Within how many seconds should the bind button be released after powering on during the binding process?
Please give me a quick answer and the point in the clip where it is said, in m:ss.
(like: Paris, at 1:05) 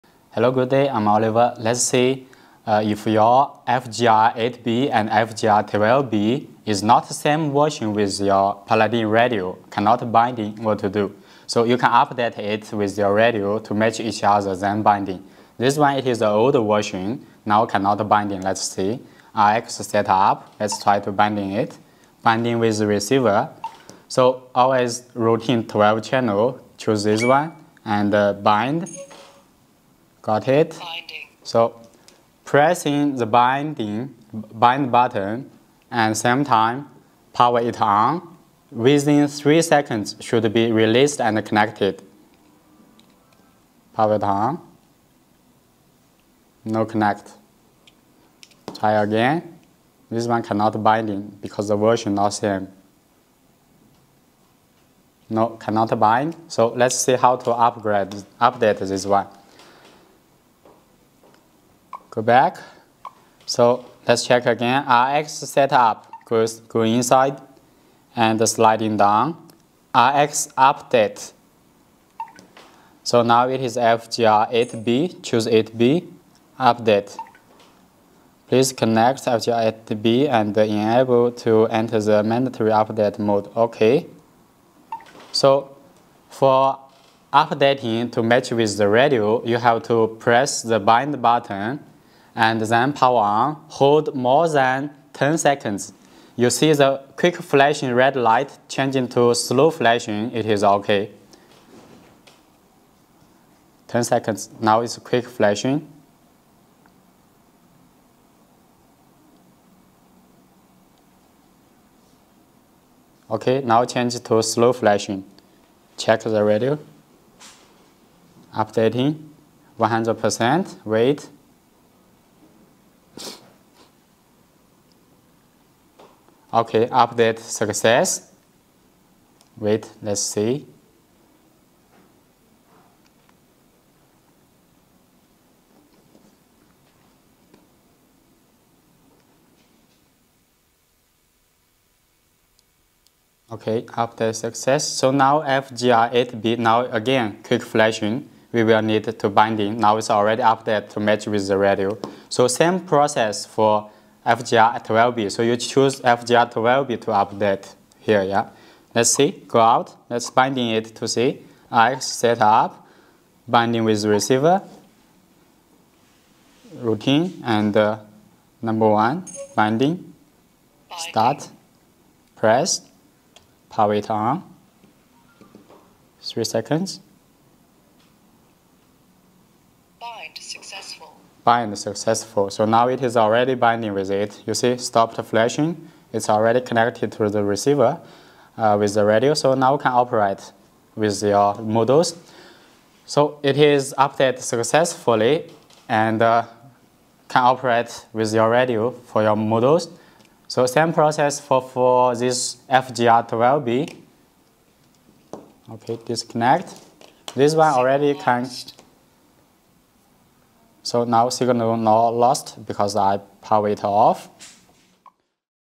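3 seconds, at 0:38.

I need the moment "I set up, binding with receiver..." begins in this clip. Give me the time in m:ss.
2:41.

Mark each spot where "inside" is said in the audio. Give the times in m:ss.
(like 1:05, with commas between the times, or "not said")
1:06.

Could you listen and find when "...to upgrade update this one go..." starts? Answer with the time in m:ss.
0:57.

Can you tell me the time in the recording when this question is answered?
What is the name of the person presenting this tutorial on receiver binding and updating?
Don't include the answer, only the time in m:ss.
0:01.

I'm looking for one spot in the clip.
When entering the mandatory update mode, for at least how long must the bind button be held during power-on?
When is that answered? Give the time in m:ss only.
1:34.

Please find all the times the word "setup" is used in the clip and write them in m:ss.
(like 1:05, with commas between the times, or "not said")
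0:19, 1:05.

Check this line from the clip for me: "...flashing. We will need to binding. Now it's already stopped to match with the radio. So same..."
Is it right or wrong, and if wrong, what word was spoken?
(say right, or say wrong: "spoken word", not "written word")
wrong: "updated", not "stopped".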